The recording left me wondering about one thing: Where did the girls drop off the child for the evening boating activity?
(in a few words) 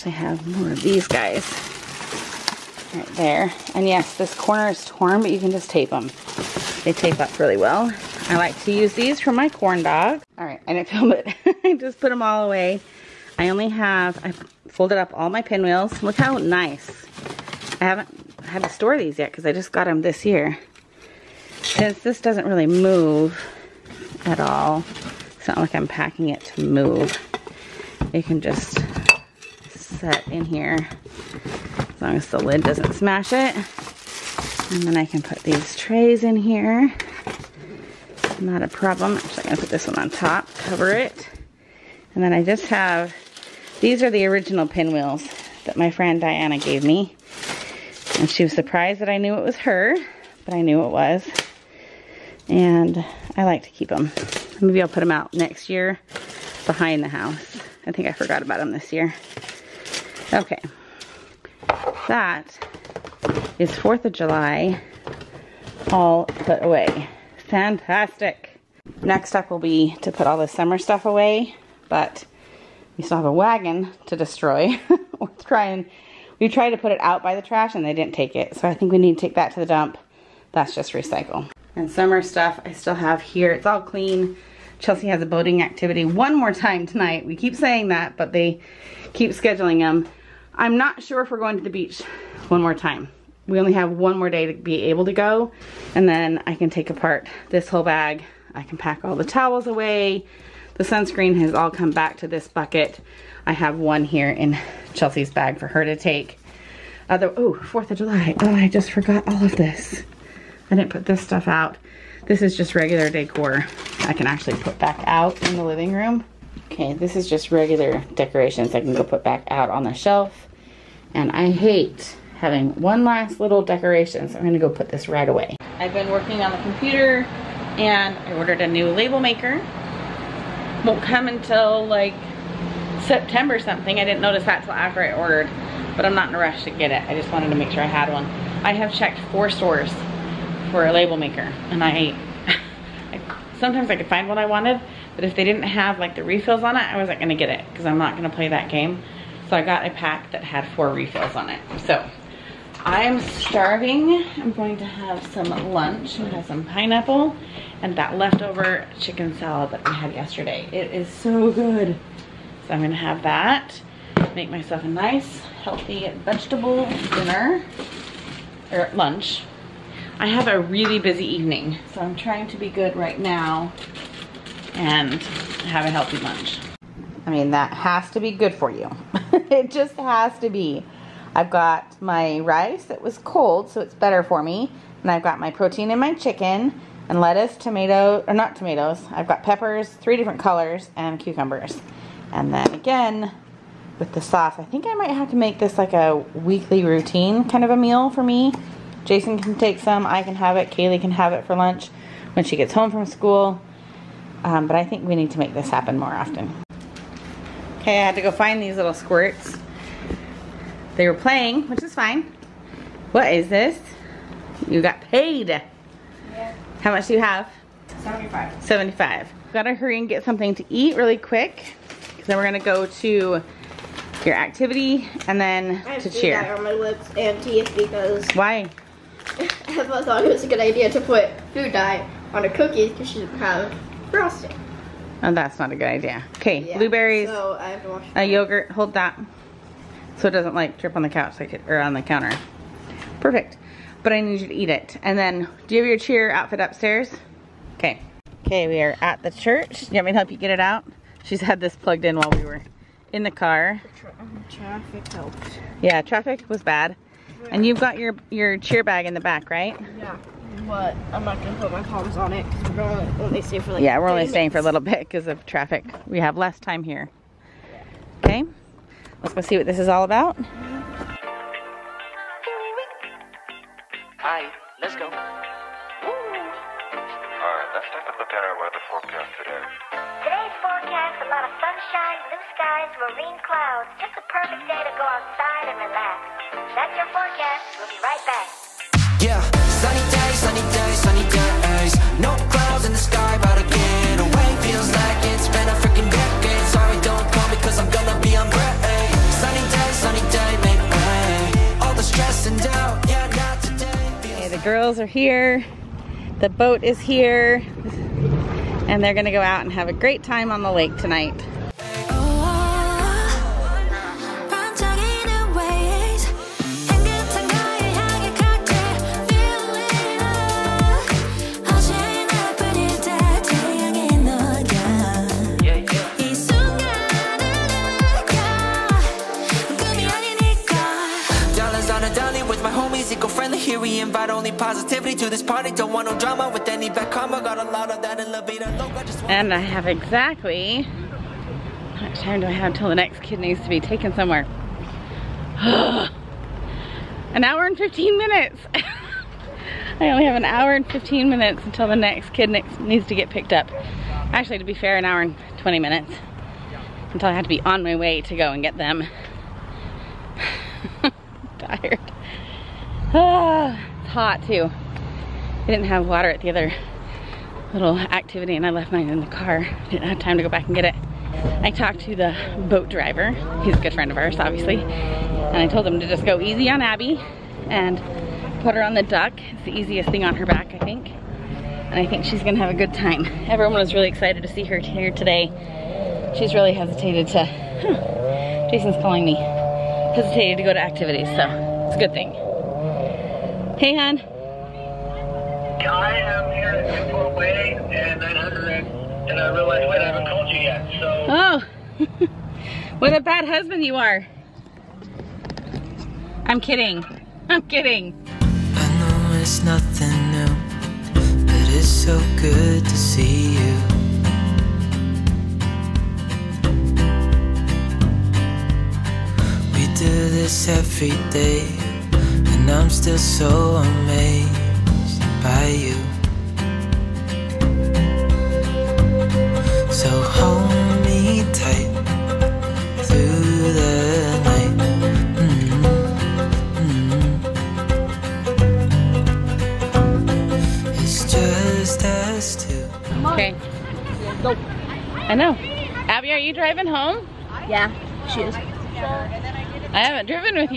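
the church.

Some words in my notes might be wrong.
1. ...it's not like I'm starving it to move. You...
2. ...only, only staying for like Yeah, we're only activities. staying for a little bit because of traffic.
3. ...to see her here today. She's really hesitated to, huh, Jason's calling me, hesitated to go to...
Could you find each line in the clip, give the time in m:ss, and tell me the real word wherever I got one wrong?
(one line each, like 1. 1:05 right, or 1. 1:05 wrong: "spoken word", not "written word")
1. 0:25 wrong: "packing", not "starving"
2. 4:22 wrong: "minutes", not "activities"
3. 6:24 right.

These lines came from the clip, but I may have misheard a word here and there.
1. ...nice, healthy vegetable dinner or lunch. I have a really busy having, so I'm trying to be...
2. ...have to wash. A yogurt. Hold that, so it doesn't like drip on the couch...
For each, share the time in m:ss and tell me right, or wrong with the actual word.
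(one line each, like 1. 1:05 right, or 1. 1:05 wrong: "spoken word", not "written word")
1. 2:44 wrong: "evening", not "having"
2. 3:57 right.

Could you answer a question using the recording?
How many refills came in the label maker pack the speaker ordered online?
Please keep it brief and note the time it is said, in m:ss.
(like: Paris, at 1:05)
4, at 2:30.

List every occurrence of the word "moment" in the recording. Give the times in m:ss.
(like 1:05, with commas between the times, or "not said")
not said.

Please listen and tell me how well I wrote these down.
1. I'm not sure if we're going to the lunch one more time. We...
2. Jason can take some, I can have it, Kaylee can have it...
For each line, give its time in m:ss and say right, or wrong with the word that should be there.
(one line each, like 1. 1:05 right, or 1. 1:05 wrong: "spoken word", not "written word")
1. 1:30 wrong: "beach", not "lunch"
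2. 3:19 right.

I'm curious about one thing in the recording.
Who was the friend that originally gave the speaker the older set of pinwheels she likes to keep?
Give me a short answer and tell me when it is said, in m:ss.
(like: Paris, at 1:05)
Diana, at 0:46.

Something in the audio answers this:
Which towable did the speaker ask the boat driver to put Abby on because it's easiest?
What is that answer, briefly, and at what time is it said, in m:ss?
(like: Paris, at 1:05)
the duck, at 6:18.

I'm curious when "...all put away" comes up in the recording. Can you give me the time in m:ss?
1:05.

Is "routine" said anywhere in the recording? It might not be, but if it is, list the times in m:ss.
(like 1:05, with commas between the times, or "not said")
3:16.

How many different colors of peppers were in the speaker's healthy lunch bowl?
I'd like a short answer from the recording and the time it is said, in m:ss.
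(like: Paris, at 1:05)
3, at 3:09.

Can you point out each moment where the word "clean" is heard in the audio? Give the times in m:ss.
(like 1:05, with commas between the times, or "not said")
1:23.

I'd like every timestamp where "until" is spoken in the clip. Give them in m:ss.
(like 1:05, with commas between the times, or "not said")
2:11, 5:42, 5:51, 5:57.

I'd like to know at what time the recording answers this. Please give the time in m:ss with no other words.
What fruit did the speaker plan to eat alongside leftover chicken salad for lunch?
2:36.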